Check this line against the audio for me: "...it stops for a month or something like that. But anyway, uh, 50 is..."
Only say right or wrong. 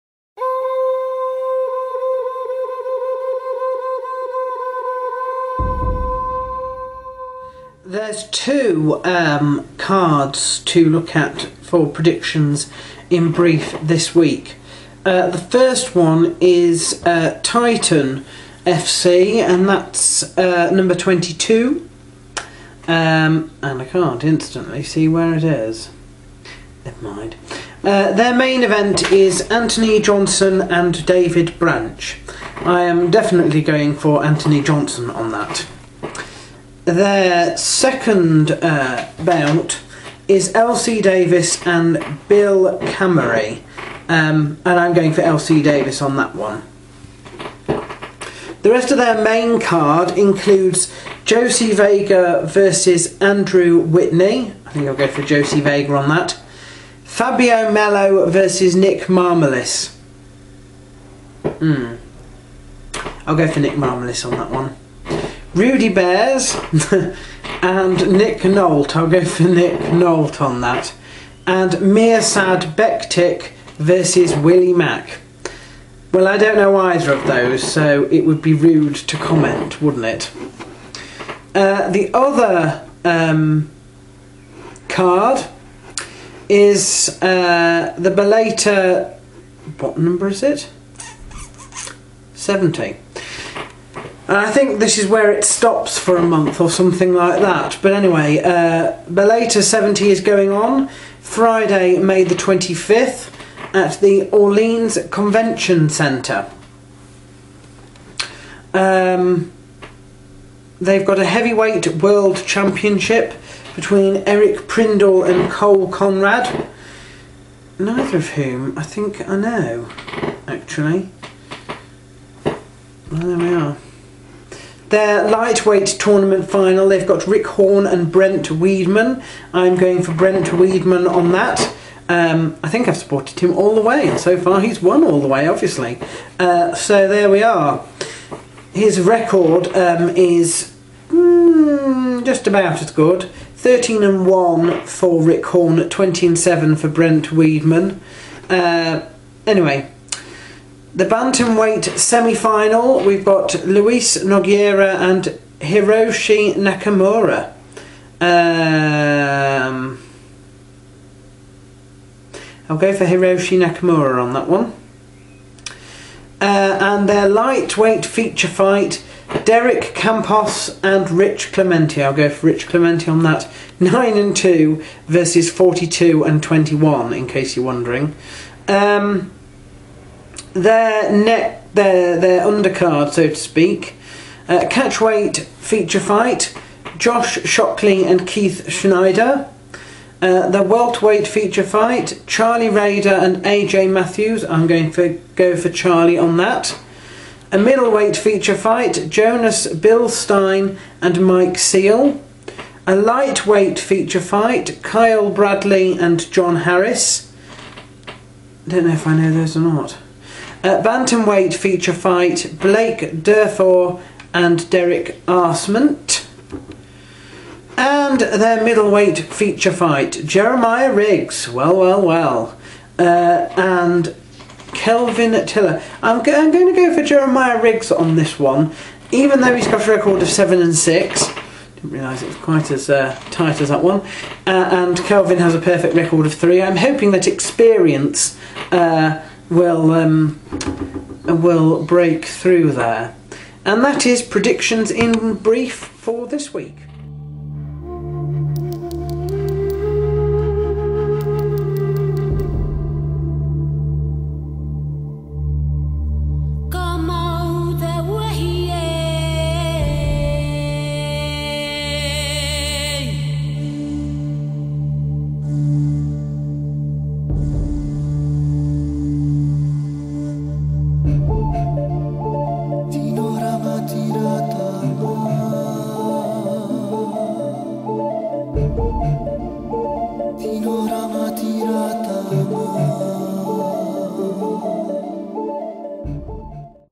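wrong.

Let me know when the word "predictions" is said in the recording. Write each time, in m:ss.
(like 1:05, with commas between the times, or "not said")
0:11, 4:04.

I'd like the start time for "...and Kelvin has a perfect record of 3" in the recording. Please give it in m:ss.
3:54.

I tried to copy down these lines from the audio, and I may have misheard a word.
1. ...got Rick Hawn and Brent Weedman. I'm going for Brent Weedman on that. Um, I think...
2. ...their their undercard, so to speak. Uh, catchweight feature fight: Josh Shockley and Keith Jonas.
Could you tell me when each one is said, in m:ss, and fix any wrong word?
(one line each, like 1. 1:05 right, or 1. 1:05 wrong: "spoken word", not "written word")
1. 2:07 right
2. 3:01 wrong: "Schneider", not "Jonas".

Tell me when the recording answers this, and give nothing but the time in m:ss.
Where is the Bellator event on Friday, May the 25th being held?
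1:44.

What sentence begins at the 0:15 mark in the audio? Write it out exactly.
Uh, the first one is uh, Titan FC, and that's uh, number 22.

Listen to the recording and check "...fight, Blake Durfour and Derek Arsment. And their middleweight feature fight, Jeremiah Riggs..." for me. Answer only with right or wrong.
right.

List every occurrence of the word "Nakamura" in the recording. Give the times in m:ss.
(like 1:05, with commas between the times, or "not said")
2:36, 2:43.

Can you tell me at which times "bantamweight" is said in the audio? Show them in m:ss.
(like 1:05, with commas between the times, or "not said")
2:31, 3:30.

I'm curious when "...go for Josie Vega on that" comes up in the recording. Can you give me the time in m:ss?
0:54.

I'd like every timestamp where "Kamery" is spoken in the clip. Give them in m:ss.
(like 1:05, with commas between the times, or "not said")
0:42.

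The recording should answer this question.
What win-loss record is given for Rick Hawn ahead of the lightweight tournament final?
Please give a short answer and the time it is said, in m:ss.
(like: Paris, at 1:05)
13 and 1, at 2:23.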